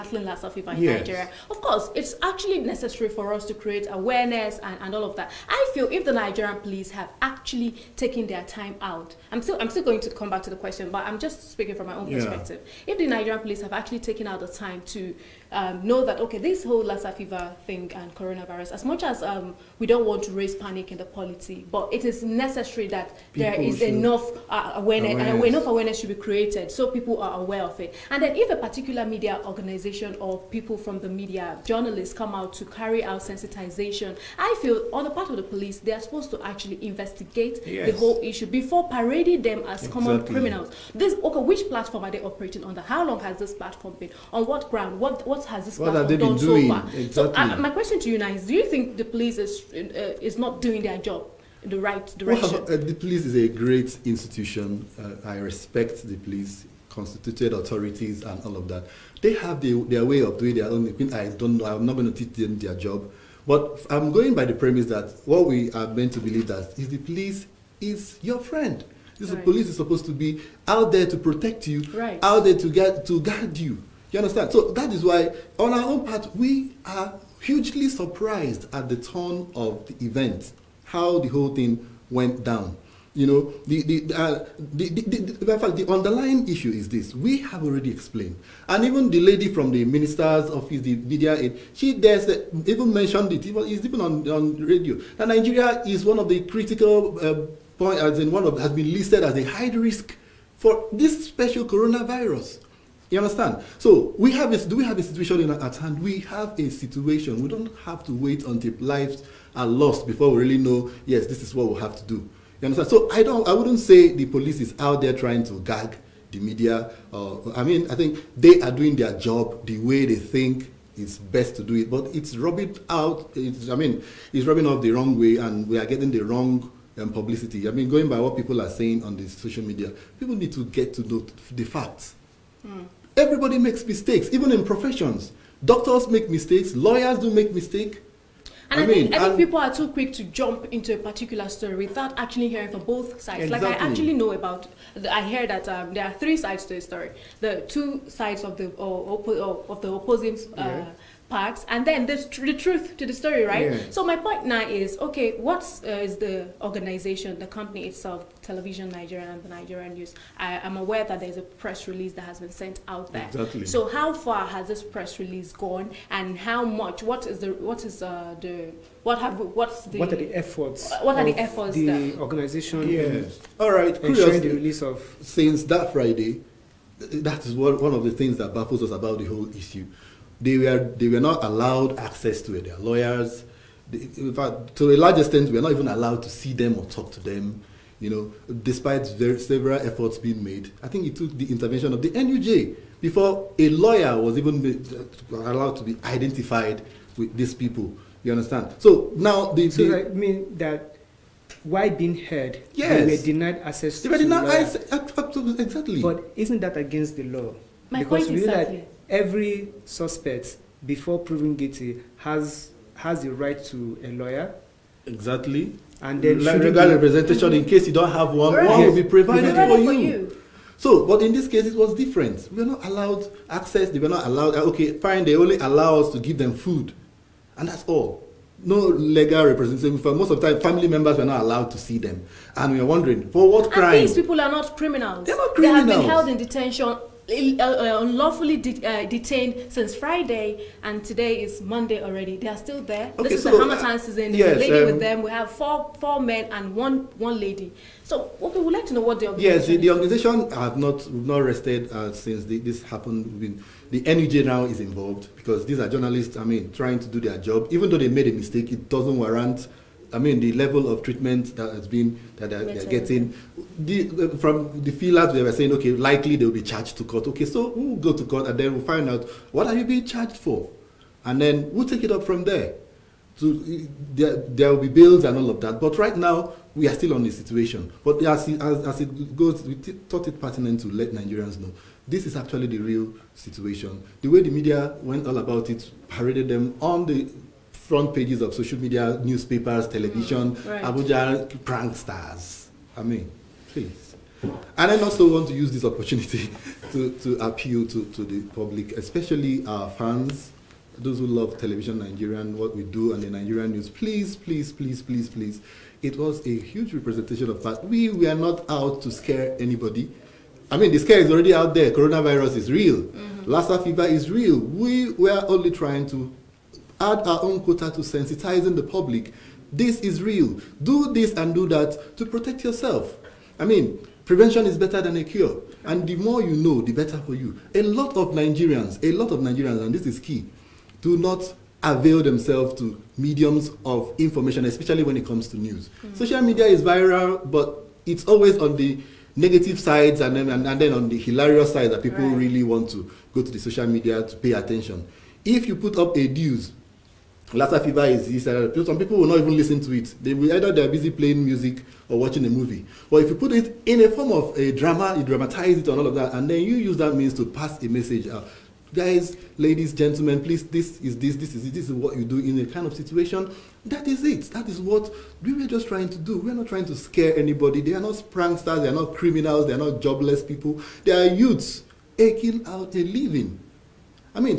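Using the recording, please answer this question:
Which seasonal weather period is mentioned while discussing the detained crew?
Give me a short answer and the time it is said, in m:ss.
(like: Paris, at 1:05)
Harmattan, at 4:03.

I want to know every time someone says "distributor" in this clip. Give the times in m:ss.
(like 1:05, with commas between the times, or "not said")
not said.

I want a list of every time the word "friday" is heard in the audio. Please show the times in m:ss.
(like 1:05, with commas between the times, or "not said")
2:55, 3:59.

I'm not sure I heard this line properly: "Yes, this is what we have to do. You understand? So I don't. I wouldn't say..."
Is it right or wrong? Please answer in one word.
right.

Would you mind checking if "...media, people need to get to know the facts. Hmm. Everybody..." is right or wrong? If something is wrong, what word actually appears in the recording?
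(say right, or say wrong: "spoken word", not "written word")
right.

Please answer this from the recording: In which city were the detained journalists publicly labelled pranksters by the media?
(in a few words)
Abuja.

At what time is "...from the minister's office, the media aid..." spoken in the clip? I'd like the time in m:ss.
1:29.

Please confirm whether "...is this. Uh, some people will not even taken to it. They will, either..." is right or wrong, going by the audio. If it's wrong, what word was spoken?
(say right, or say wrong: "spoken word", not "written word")
wrong: "listen", not "taken".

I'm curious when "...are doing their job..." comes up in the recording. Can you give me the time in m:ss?
1:58.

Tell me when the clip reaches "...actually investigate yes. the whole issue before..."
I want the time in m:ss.
0:36.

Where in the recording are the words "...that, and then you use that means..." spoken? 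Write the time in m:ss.
5:56.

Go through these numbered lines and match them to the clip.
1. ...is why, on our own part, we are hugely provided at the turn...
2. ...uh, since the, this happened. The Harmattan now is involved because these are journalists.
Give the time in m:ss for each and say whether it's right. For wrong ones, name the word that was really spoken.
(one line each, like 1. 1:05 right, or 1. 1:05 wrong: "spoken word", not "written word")
1. 1:14 wrong: "surprised", not "provided"
2. 4:11 wrong: "NUJ", not "Harmattan".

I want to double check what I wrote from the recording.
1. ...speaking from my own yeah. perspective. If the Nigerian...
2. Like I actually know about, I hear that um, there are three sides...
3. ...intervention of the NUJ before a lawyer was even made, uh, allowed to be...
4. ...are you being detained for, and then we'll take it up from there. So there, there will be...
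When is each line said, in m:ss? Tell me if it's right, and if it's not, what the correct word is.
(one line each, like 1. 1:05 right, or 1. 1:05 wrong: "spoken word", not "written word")
1. 0:11 right
2. 2:23 right
3. 3:11 right
4. 4:29 wrong: "charged", not "detained".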